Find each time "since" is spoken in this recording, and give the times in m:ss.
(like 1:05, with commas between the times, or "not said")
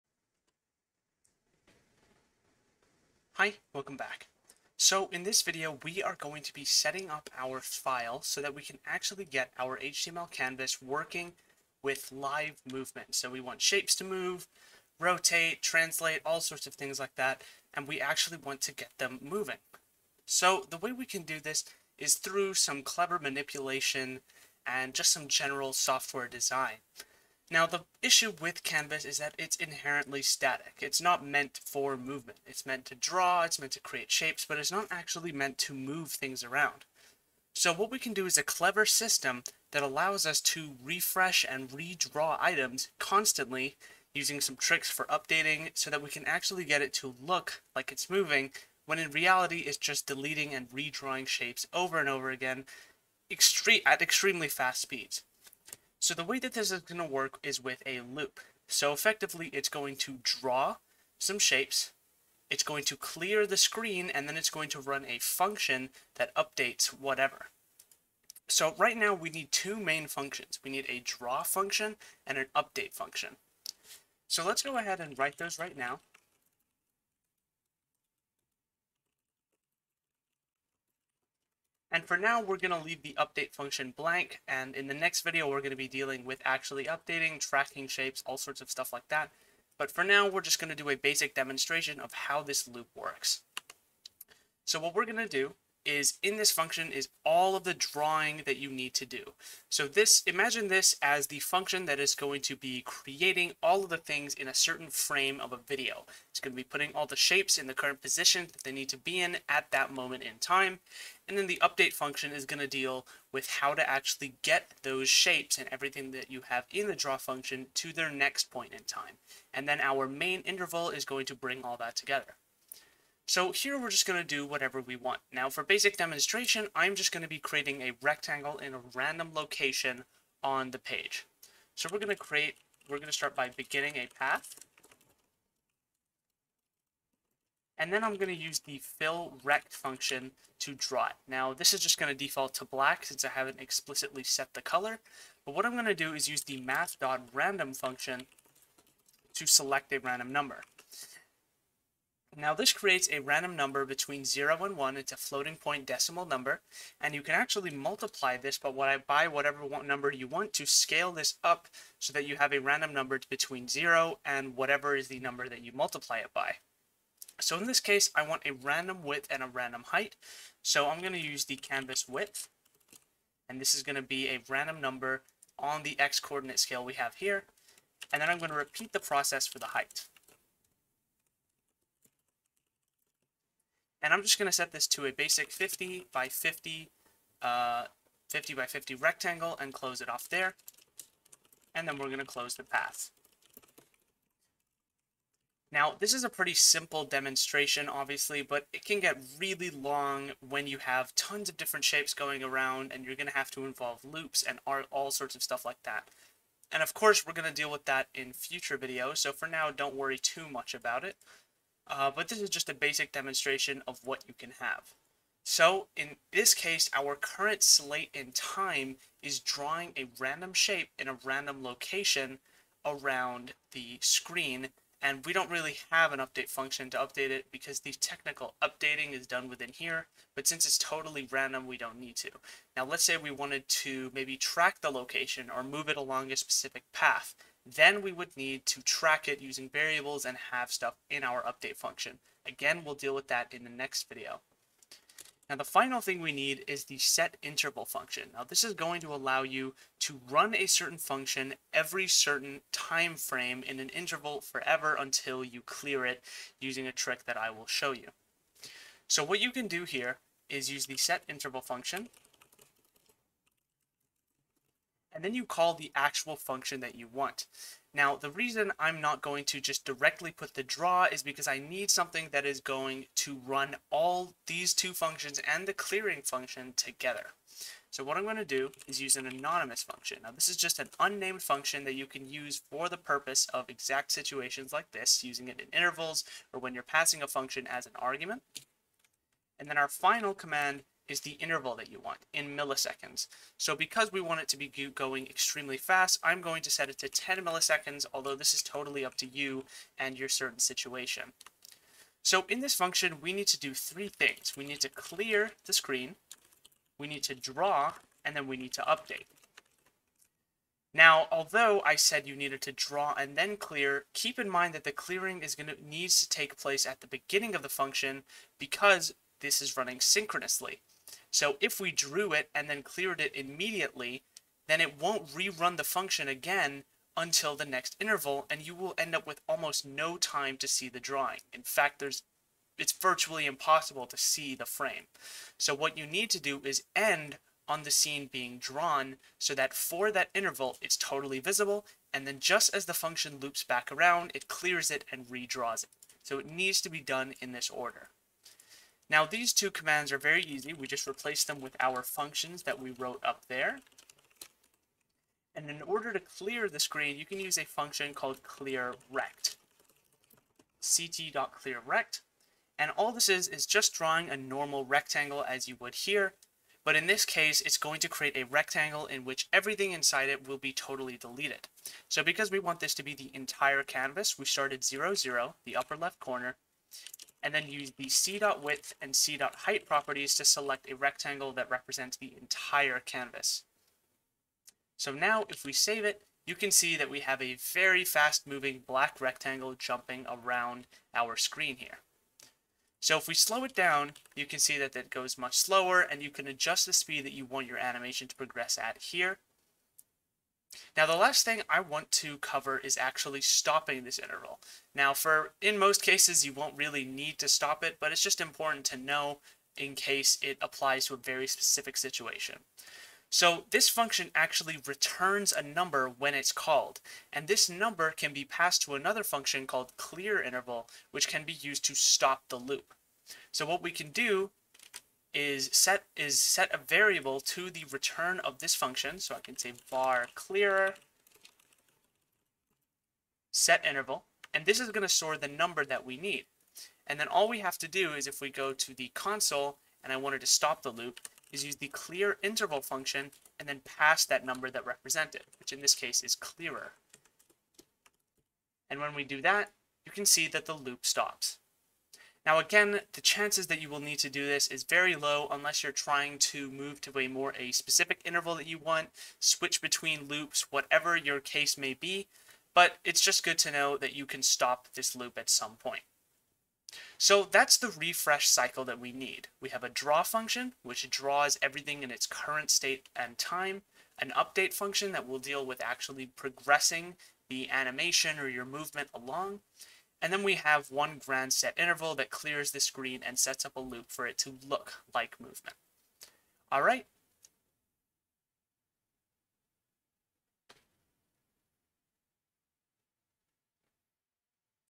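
2:23, 3:50.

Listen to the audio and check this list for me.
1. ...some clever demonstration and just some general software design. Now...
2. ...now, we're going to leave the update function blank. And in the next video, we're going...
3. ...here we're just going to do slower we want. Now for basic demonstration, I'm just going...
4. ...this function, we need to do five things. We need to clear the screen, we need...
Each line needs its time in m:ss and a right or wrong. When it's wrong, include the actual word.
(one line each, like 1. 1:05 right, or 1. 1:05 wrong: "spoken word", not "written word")
1. 0:22 wrong: "manipulation", not "demonstration"
2. 1:22 right
3. 2:03 wrong: "whatever", not "slower"
4. 5:02 wrong: "three", not "five".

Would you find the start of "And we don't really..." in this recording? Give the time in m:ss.
3:45.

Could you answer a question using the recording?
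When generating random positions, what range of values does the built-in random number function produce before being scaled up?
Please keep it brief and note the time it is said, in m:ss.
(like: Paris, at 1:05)
between 0 and 1, at 2:33.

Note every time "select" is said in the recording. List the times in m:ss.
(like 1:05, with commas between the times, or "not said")
2:29, 6:20.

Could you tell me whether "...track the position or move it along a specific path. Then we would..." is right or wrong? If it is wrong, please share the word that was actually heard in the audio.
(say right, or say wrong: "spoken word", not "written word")
wrong: "location", not "position".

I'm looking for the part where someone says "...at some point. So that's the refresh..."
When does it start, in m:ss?
7:45.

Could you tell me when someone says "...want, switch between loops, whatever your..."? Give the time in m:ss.
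7:38.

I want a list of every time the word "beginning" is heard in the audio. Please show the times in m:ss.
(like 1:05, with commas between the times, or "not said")
2:13, 5:17.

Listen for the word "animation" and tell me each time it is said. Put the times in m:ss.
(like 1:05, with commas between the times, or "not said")
6:37, 7:57.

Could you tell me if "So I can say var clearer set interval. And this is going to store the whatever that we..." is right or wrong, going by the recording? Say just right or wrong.
wrong.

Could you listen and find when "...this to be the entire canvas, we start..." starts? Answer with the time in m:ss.
6:12.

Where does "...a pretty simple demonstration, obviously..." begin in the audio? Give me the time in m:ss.
3:16.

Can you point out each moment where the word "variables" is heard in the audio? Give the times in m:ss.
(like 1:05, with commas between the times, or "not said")
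3:59, 7:06.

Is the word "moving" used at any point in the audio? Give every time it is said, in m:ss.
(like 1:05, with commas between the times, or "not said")
0:19, 0:48, 6:28.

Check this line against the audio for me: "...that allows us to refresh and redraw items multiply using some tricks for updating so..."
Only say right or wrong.
wrong.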